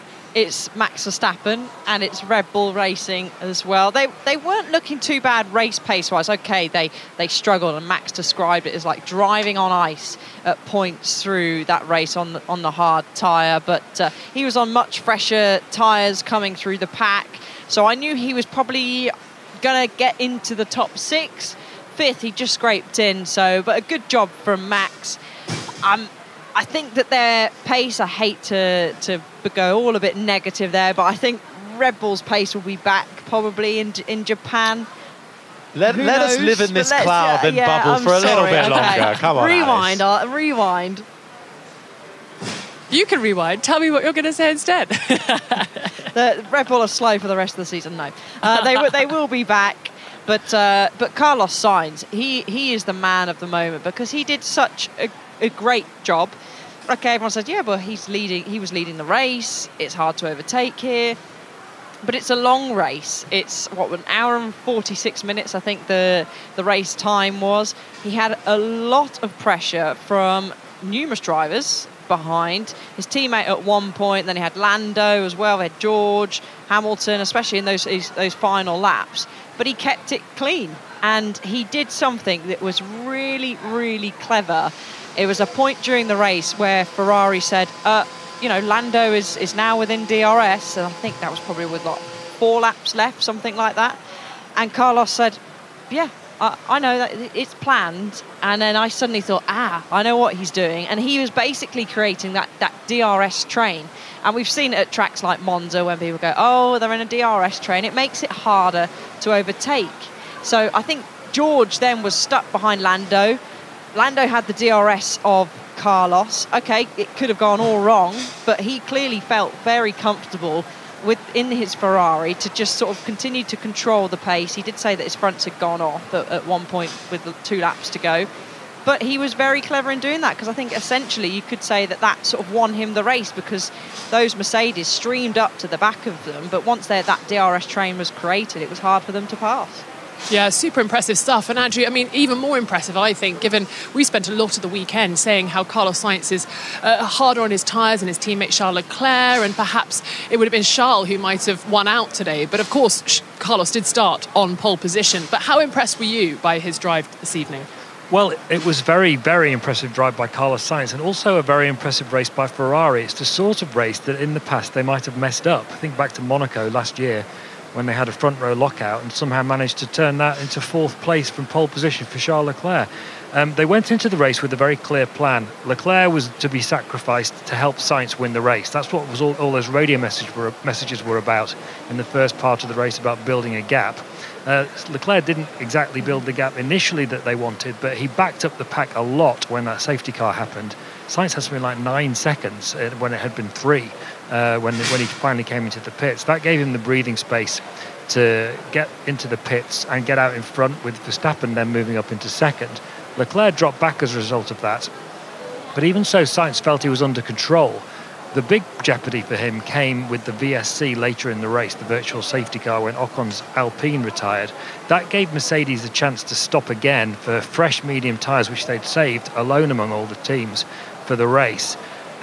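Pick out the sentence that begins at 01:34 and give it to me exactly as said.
And Carlos said, yeah, I, I know that it's planned.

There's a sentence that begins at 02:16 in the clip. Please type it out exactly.
But once that DRS train was created, it was hard for them to pass.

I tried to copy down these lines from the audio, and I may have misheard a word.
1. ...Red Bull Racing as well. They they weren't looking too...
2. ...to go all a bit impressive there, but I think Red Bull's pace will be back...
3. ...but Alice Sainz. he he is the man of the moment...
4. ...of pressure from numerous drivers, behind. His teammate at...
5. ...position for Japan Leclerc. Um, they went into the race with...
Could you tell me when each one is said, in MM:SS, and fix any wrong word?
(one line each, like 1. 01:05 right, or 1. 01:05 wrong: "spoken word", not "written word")
1. 00:02 right
2. 00:29 wrong: "negative", not "impressive"
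3. 00:50 wrong: "Carlos", not "Alice"
4. 01:09 right
5. 02:51 wrong: "Charles", not "Japan".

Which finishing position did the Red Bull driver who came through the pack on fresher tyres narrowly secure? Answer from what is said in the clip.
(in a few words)
5th.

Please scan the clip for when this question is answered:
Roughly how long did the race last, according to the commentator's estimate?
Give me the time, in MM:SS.
01:03.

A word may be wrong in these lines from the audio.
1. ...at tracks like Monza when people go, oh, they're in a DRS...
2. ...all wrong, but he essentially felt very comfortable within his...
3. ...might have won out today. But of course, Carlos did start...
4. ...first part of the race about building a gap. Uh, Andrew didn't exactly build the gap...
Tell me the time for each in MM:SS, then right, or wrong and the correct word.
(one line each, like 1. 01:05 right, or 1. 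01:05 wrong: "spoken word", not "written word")
1. 01:44 right
2. 01:57 wrong: "clearly", not "essentially"
3. 02:31 right
4. 03:02 wrong: "Leclerc", not "Andrew".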